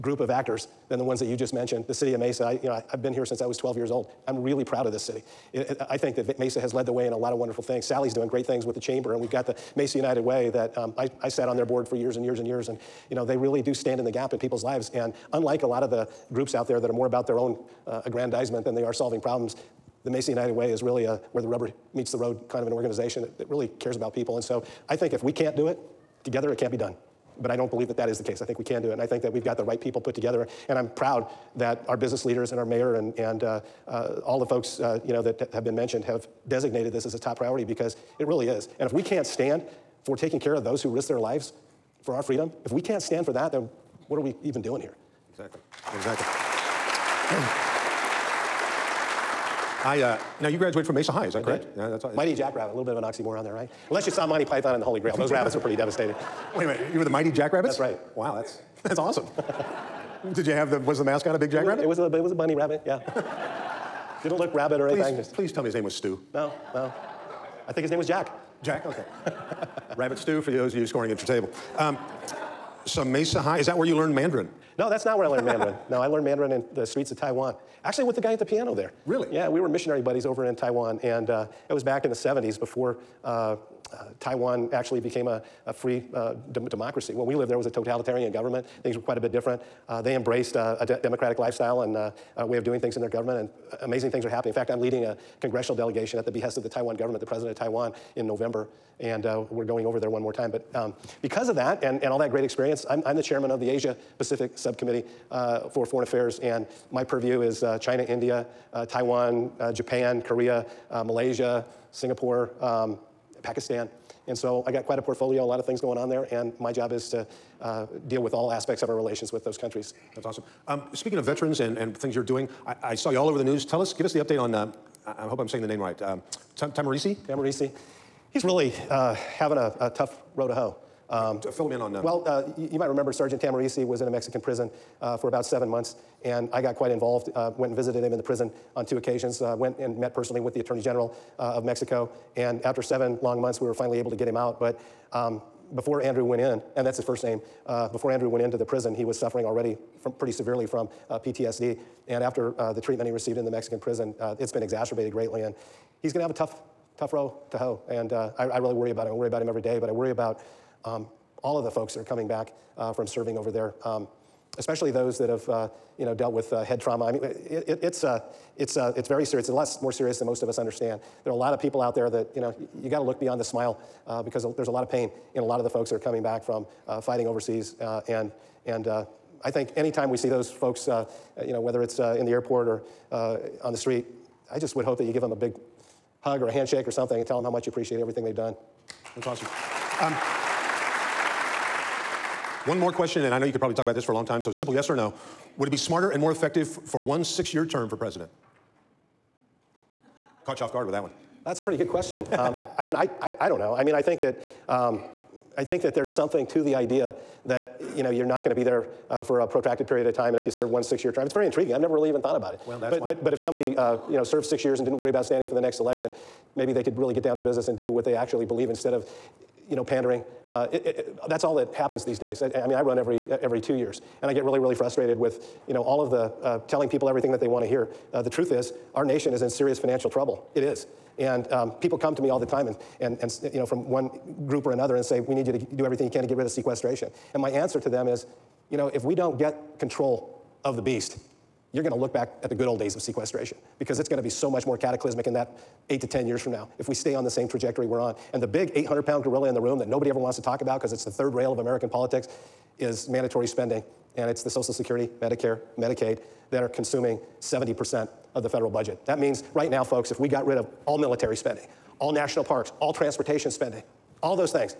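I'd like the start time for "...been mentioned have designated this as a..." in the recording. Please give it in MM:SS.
00:35.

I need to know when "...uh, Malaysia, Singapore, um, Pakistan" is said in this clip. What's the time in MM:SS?
01:50.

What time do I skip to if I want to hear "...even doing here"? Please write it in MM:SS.
00:44.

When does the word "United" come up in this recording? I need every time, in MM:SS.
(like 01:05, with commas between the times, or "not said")
00:09, 00:20.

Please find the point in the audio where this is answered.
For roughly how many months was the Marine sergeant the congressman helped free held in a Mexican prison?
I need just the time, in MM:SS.
02:15.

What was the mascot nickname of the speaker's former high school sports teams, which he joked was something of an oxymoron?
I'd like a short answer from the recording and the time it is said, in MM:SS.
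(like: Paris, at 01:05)
Mighty Jackrabbit, at 00:52.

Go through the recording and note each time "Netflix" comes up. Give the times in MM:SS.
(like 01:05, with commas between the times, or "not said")
not said.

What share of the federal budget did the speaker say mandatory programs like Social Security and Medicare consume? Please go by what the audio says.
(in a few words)
70%.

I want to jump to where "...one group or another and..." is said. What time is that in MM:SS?
03:53.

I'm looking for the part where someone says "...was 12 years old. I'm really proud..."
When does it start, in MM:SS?
00:03.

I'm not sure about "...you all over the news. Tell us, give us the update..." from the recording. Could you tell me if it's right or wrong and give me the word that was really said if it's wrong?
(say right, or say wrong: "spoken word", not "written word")
right.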